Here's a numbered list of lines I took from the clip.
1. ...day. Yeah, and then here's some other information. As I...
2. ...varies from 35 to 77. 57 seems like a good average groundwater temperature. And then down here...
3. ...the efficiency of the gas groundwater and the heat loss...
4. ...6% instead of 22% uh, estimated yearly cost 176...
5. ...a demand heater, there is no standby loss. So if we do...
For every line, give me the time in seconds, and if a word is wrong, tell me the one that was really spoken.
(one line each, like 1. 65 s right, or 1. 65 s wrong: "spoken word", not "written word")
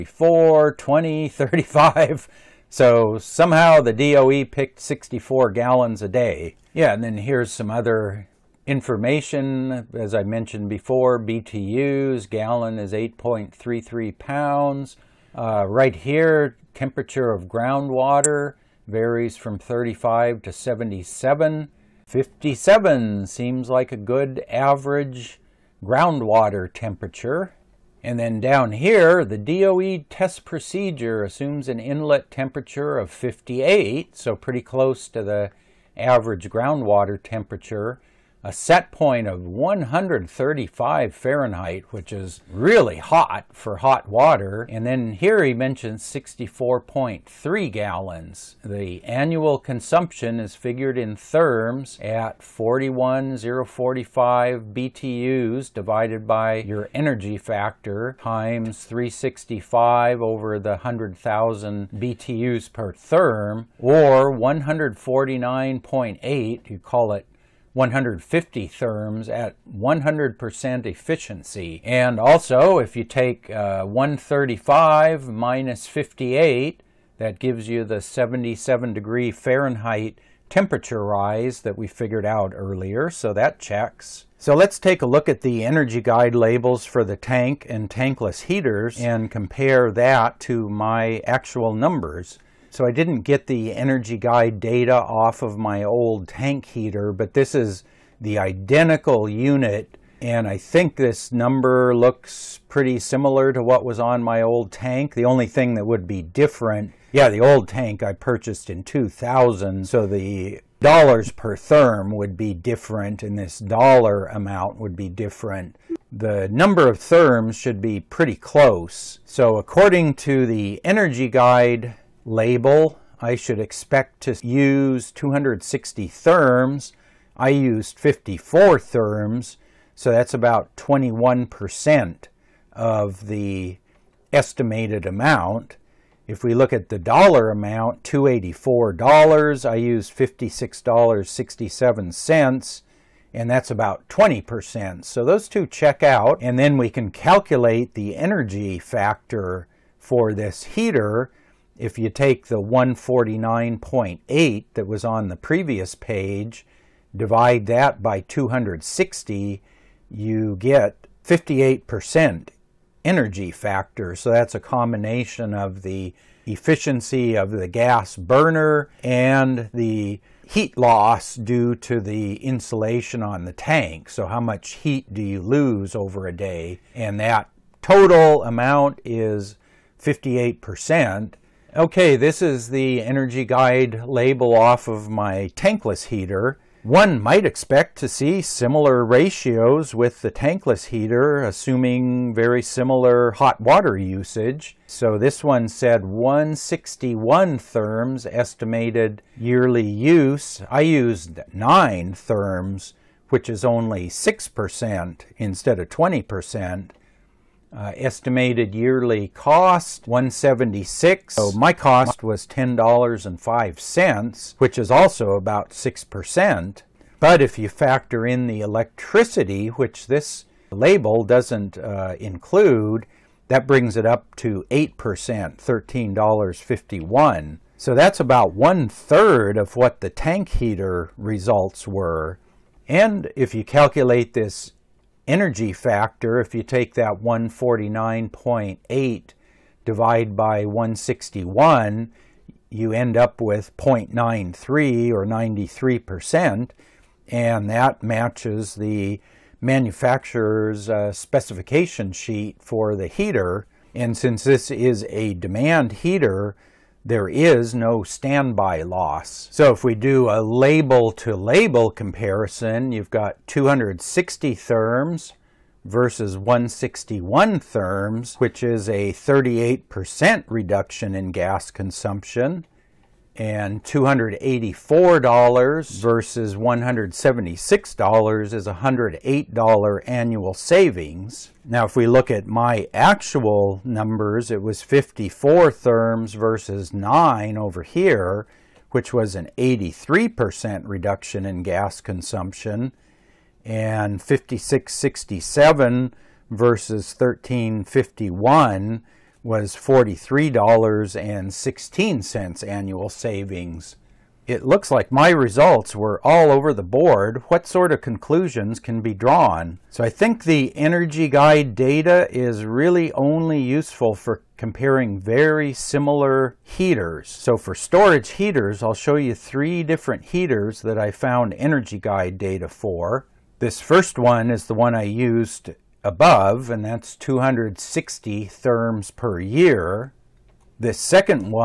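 1. 6 s right
2. 18 s right
3. 165 s wrong: "burner", not "groundwater"
4. 204 s wrong: "20", not "22"
5. 255 s right.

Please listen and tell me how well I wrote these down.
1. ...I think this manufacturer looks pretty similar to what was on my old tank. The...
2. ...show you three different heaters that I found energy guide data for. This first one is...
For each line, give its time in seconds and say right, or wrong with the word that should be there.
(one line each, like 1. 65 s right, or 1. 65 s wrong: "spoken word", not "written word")
1. 100 s wrong: "number", not "manufacturer"
2. 318 s right.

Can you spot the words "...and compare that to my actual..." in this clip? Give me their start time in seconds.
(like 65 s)
89 s.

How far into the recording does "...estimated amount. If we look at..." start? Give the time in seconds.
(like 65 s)
134 s.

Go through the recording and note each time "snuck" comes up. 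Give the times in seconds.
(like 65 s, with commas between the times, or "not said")
not said.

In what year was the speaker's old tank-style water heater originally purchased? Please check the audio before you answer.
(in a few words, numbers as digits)
2000.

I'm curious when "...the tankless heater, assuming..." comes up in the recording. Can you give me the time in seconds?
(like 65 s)
190 s.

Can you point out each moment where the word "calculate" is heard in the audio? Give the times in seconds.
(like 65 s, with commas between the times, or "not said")
147 s, 233 s.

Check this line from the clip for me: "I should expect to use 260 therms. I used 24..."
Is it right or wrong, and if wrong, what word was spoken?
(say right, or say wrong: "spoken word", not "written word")
wrong: "54", not "24".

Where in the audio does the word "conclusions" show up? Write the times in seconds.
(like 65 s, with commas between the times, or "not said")
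308 s.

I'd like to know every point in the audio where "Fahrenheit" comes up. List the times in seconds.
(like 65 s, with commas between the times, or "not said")
41 s, 79 s.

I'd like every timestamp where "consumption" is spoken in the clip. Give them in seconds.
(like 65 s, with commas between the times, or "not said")
49 s, 271 s, 291 s.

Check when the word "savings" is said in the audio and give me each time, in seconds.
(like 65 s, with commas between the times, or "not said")
280 s, 303 s.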